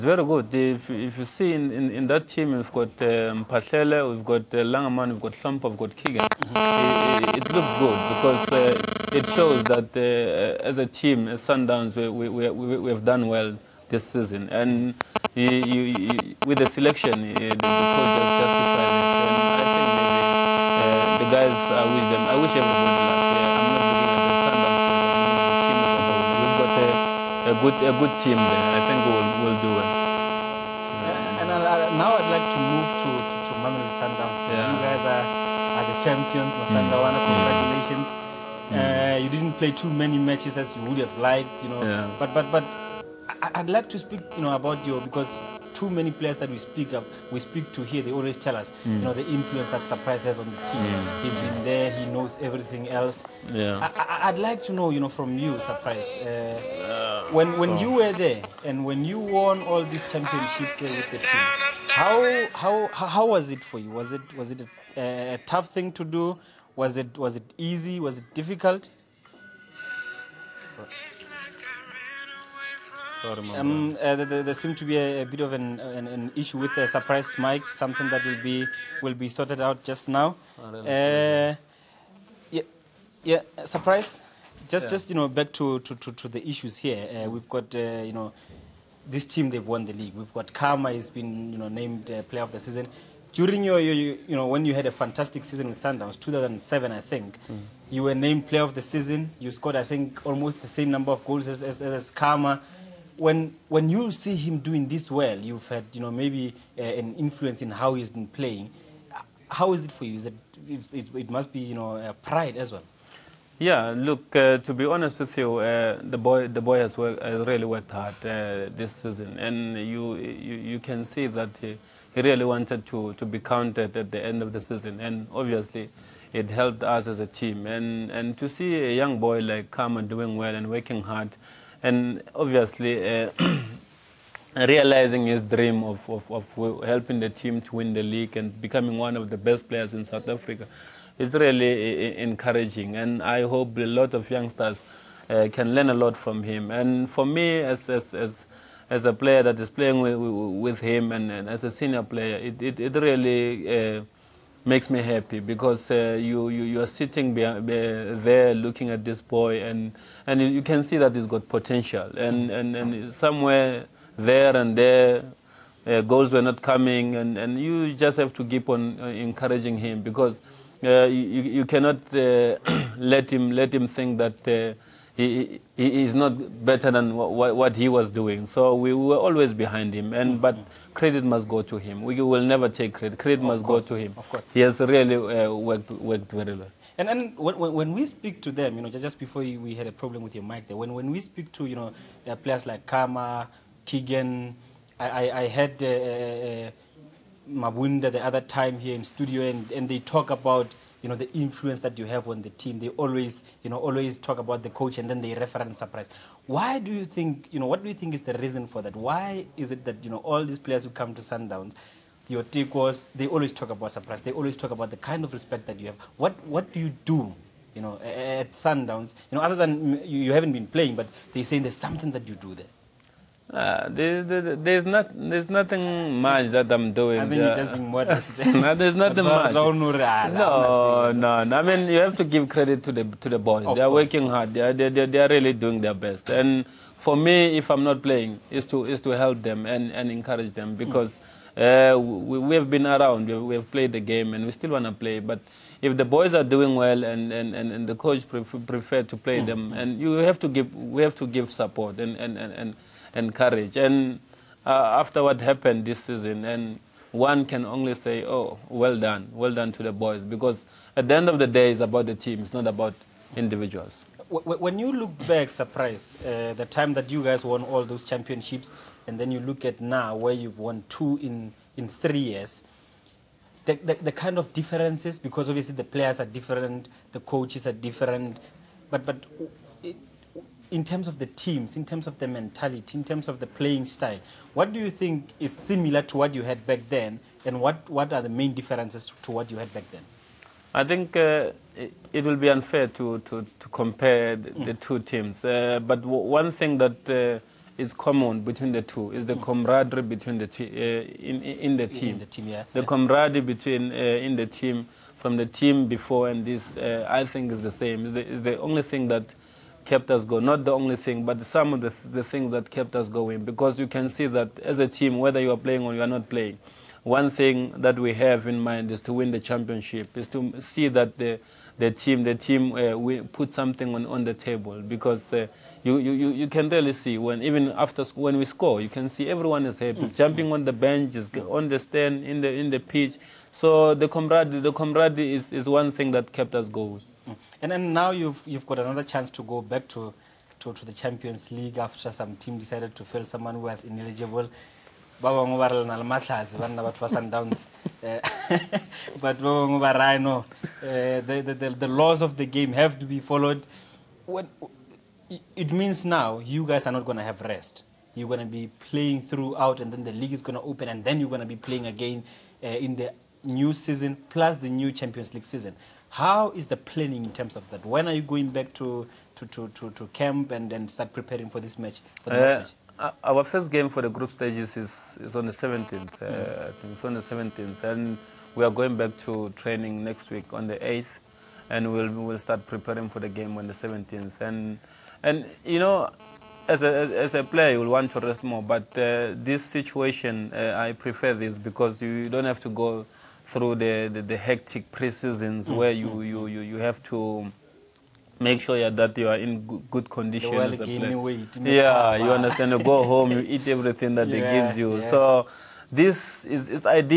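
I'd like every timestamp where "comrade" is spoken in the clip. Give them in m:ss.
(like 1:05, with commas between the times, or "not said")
5:34.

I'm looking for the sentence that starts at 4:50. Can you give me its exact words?
I think uh, it, it, will be unfair to, to, to compare the, mm.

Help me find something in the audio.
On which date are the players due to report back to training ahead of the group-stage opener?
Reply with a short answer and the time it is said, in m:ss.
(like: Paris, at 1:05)
8th, at 6:20.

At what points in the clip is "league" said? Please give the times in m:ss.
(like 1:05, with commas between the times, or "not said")
1:29, 2:18, 5:41, 6:00, 6:05.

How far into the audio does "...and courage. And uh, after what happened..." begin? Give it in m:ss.
4:13.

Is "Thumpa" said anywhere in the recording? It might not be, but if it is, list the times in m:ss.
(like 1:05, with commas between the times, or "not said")
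0:05.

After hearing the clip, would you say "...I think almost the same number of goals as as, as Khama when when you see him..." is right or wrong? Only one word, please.
right.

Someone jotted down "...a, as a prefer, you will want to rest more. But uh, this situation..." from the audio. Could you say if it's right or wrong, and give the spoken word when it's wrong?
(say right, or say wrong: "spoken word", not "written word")
wrong: "player", not "prefer".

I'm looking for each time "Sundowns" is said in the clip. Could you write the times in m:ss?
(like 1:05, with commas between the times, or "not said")
0:11, 0:34, 1:35, 3:31, 3:38.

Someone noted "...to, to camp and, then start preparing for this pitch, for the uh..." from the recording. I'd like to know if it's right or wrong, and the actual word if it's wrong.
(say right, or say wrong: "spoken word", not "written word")
wrong: "match", not "pitch".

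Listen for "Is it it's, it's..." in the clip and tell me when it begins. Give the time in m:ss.
1:50.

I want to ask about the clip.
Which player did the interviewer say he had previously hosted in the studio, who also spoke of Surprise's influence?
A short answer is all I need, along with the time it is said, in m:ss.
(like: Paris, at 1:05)
Mabunda, at 3:17.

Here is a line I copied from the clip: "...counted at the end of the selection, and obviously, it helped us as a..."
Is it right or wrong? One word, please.
wrong.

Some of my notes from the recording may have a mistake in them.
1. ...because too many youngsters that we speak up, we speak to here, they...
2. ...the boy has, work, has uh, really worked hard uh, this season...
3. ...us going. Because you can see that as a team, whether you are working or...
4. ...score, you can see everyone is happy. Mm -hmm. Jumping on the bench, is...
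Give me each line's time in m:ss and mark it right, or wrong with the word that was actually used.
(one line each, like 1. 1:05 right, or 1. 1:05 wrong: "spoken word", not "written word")
1. 0:45 wrong: "players", not "youngsters"
2. 1:56 right
3. 5:13 wrong: "playing", not "working"
4. 5:28 right.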